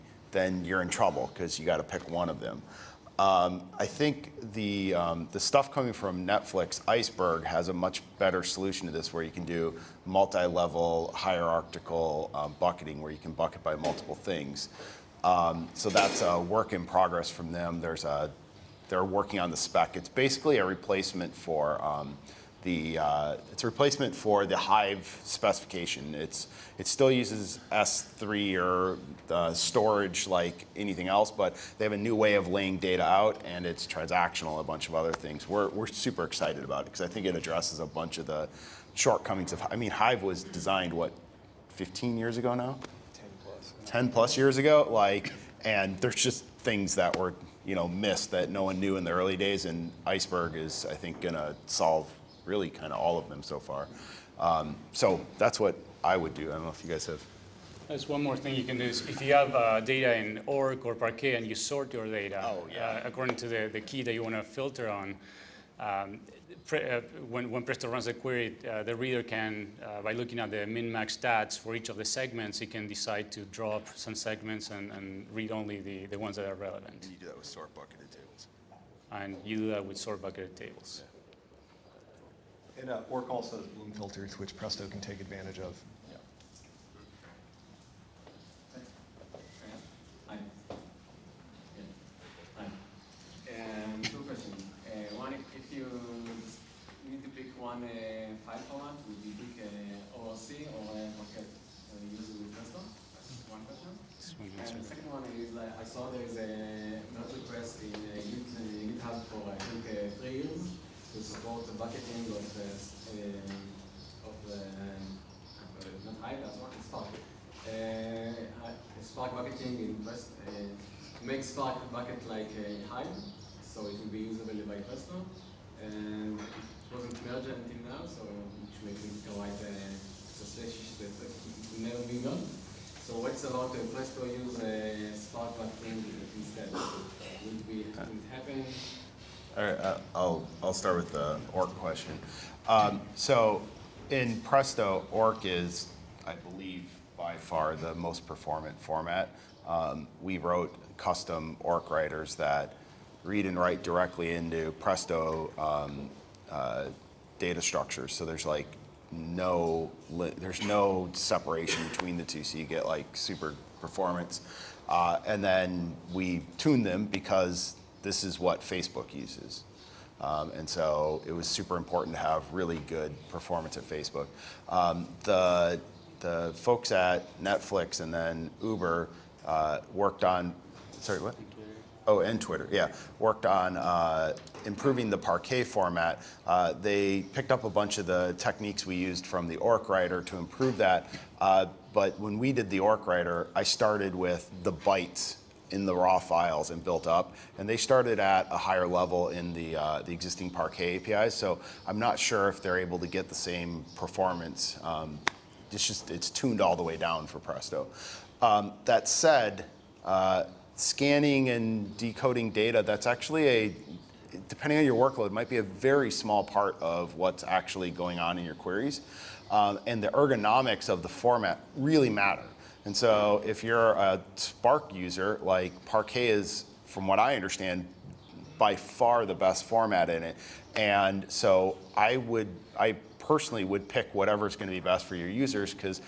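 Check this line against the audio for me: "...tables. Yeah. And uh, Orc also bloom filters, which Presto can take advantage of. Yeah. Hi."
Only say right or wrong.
right.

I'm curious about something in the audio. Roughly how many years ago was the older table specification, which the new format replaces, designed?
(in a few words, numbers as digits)
15.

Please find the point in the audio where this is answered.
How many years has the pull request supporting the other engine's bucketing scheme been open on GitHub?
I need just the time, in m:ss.
1:50.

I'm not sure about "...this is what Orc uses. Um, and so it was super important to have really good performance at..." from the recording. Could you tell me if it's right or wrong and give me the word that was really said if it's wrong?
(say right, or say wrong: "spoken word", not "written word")
wrong: "Facebook", not "Orc".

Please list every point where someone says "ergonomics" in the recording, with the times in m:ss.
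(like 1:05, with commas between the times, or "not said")
3:40.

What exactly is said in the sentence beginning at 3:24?
Um, it's just, it's tuned all the way down for Presto.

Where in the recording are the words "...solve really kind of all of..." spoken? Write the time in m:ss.
0:51.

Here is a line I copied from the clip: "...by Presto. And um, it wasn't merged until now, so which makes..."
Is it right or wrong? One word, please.
right.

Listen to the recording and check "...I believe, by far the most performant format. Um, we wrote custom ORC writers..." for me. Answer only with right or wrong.
right.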